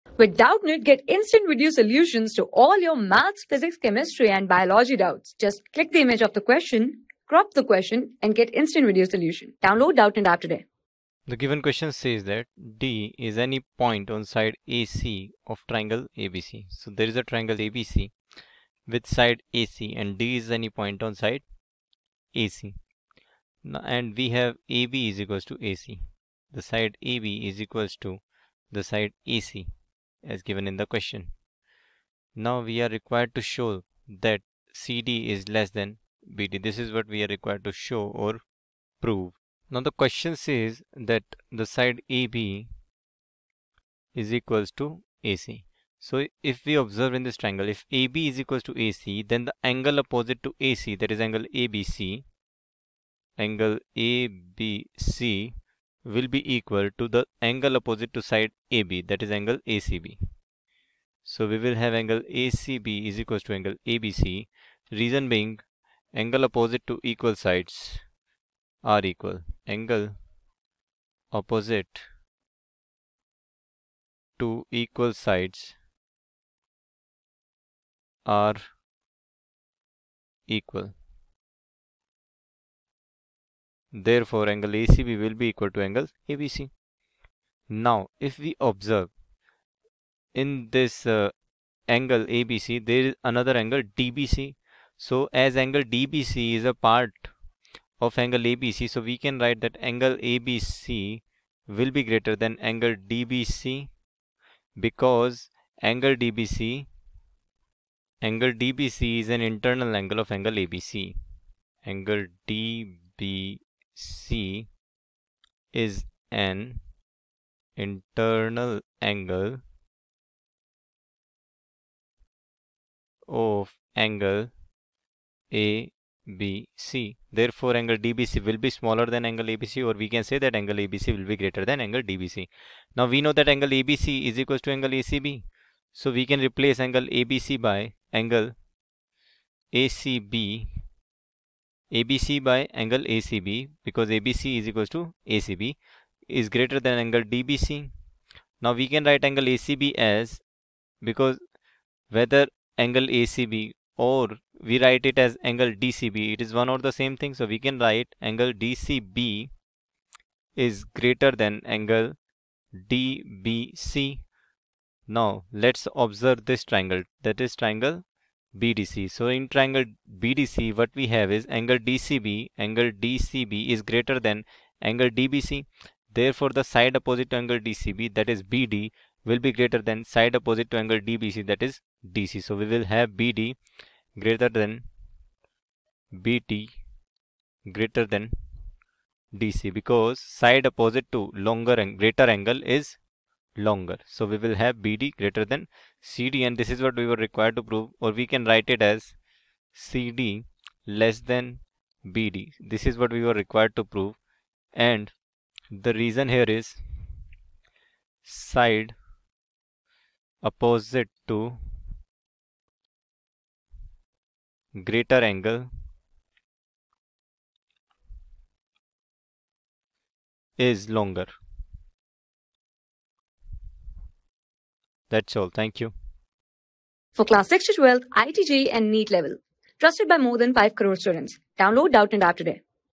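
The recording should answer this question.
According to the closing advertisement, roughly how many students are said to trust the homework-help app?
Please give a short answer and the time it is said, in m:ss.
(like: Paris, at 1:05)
more than 5 crore, at 3:50.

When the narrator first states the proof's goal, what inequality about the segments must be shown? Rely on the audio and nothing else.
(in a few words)
CD is less than BD.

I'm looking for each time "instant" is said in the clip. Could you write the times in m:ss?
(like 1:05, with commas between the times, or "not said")
0:01, 0:08.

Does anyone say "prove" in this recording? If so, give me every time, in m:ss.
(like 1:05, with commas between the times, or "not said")
0:39, 3:17, 3:23.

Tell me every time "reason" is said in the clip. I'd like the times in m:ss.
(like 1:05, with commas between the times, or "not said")
1:04, 3:25.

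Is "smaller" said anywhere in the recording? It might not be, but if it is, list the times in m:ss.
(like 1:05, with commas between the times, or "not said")
2:08.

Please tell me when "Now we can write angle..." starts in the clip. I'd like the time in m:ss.
2:28.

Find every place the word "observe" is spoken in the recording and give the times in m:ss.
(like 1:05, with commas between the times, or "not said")
0:46, 1:28, 2:45.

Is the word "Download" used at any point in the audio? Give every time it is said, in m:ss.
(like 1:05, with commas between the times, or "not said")
0:09, 3:51.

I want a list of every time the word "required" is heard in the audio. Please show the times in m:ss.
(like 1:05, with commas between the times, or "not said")
0:32, 0:37, 3:17, 3:23.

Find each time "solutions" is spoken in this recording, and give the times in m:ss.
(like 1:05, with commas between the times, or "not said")
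0:01, 0:09.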